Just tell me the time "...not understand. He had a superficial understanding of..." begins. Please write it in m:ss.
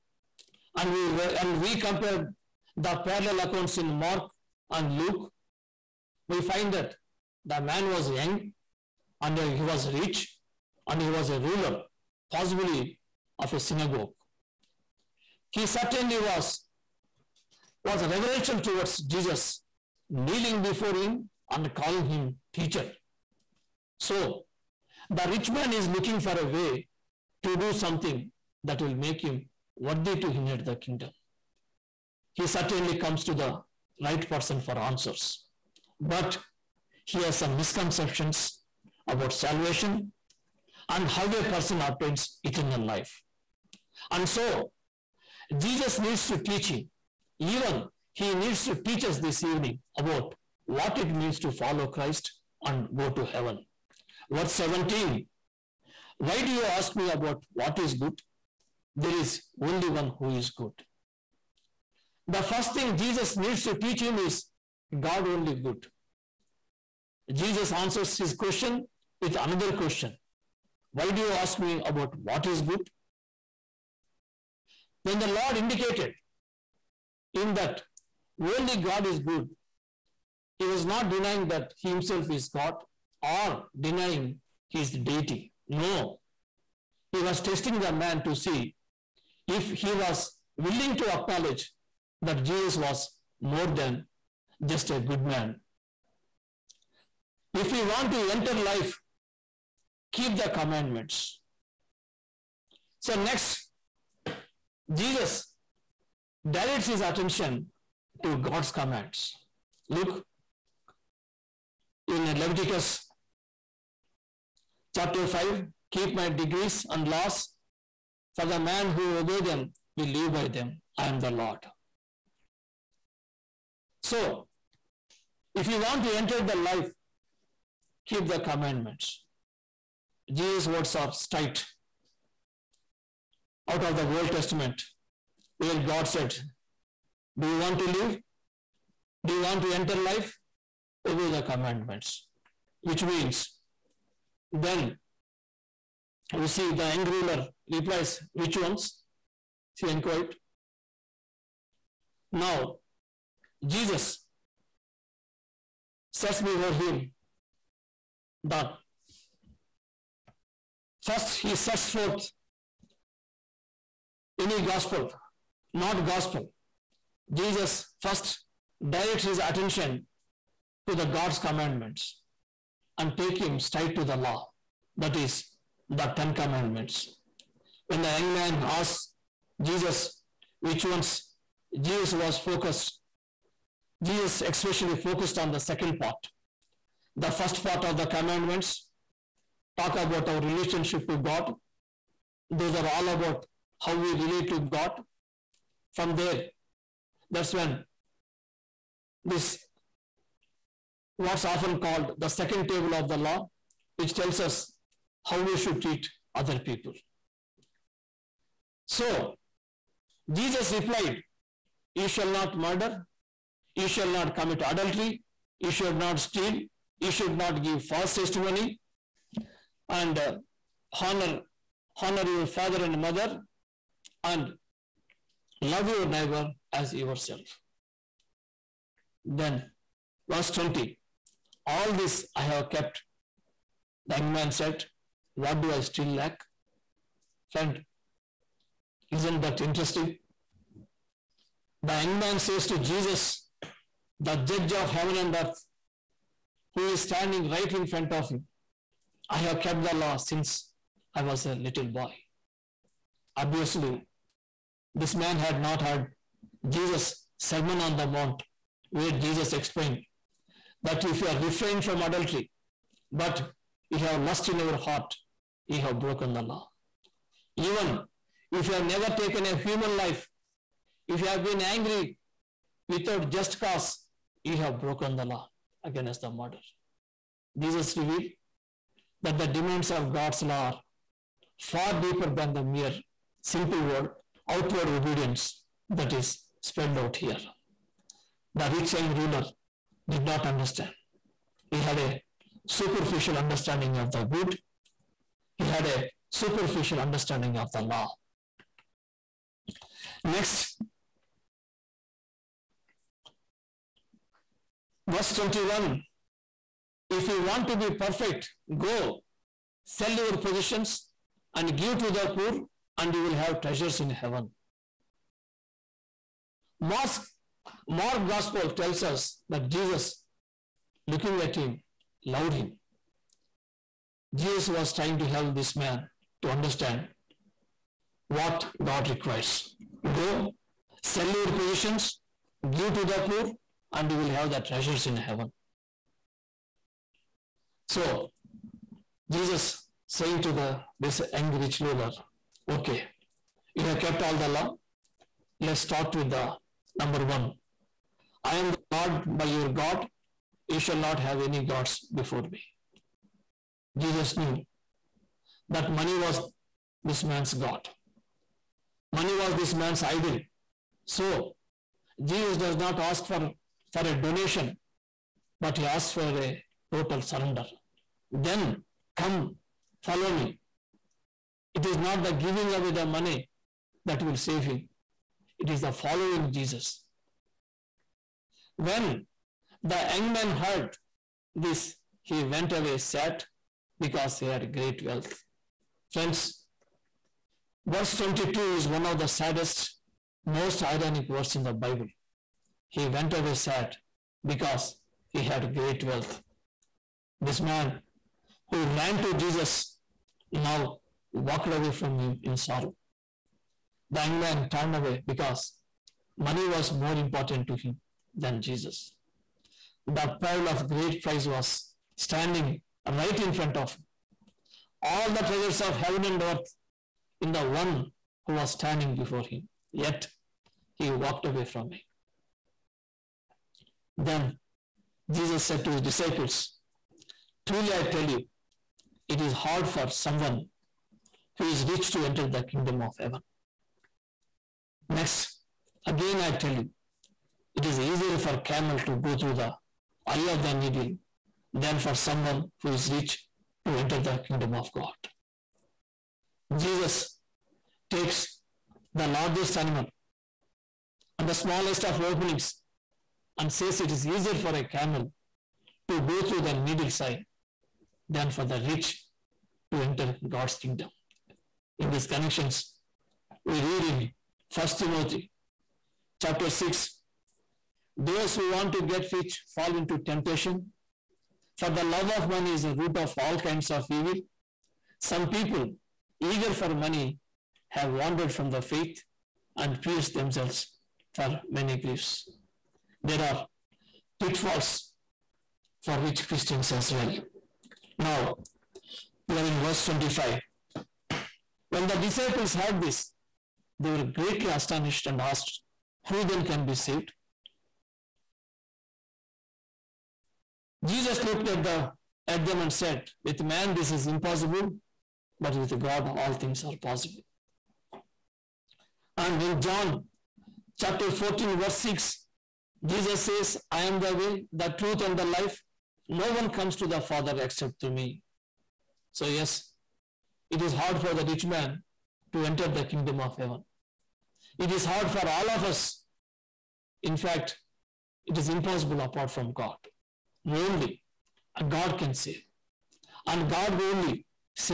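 4:50.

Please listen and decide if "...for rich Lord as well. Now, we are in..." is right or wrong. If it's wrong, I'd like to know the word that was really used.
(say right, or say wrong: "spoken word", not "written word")
wrong: "Christians", not "Lord".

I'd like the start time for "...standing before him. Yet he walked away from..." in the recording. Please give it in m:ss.
6:58.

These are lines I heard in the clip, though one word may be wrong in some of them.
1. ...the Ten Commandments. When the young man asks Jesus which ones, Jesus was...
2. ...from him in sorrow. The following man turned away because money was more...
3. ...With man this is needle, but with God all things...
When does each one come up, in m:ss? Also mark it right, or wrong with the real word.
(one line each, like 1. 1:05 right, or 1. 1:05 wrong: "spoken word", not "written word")
1. 2:55 right
2. 6:41 wrong: "young", not "following"
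3. 8:23 wrong: "impossible", not "needle".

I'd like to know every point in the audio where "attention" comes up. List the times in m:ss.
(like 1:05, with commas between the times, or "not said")
1:47, 2:49.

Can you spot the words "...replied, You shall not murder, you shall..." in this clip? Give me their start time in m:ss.
3:30.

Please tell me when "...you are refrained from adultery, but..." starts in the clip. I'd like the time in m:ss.
4:21.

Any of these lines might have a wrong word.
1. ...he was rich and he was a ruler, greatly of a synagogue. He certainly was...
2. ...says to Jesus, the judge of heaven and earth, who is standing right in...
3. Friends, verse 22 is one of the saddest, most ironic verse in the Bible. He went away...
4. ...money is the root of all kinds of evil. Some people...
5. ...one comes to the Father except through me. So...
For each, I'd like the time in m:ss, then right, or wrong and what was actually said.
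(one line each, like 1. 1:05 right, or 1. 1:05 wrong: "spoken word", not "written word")
1. 0:09 wrong: "possibly", not "greatly"
2. 4:02 right
3. 6:26 right
4. 7:52 right
5. 8:36 right.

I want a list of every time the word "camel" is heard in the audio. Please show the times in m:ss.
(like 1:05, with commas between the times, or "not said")
7:18, 7:34.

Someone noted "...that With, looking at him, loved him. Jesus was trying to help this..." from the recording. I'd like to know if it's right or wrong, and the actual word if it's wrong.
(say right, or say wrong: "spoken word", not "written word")
wrong: "Jesus", not "With".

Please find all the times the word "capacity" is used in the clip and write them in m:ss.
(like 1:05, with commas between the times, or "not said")
not said.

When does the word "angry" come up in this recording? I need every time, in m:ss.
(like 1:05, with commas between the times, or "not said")
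2:26, 4:31, 5:41.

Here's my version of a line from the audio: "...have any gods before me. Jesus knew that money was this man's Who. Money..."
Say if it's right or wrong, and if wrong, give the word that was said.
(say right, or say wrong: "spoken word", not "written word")
wrong: "God", not "Who".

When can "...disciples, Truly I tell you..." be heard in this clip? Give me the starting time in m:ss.
7:06.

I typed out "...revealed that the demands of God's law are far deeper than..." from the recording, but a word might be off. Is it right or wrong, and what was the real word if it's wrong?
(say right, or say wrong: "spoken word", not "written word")
right.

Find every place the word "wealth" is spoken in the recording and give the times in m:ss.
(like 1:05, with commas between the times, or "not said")
6:25, 6:36.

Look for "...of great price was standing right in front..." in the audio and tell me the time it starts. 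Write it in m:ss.
6:50.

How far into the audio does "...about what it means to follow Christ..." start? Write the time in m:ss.
0:49.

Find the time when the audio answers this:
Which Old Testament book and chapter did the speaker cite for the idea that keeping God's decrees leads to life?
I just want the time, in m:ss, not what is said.
1:52.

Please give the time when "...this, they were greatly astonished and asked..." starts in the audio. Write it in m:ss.
8:12.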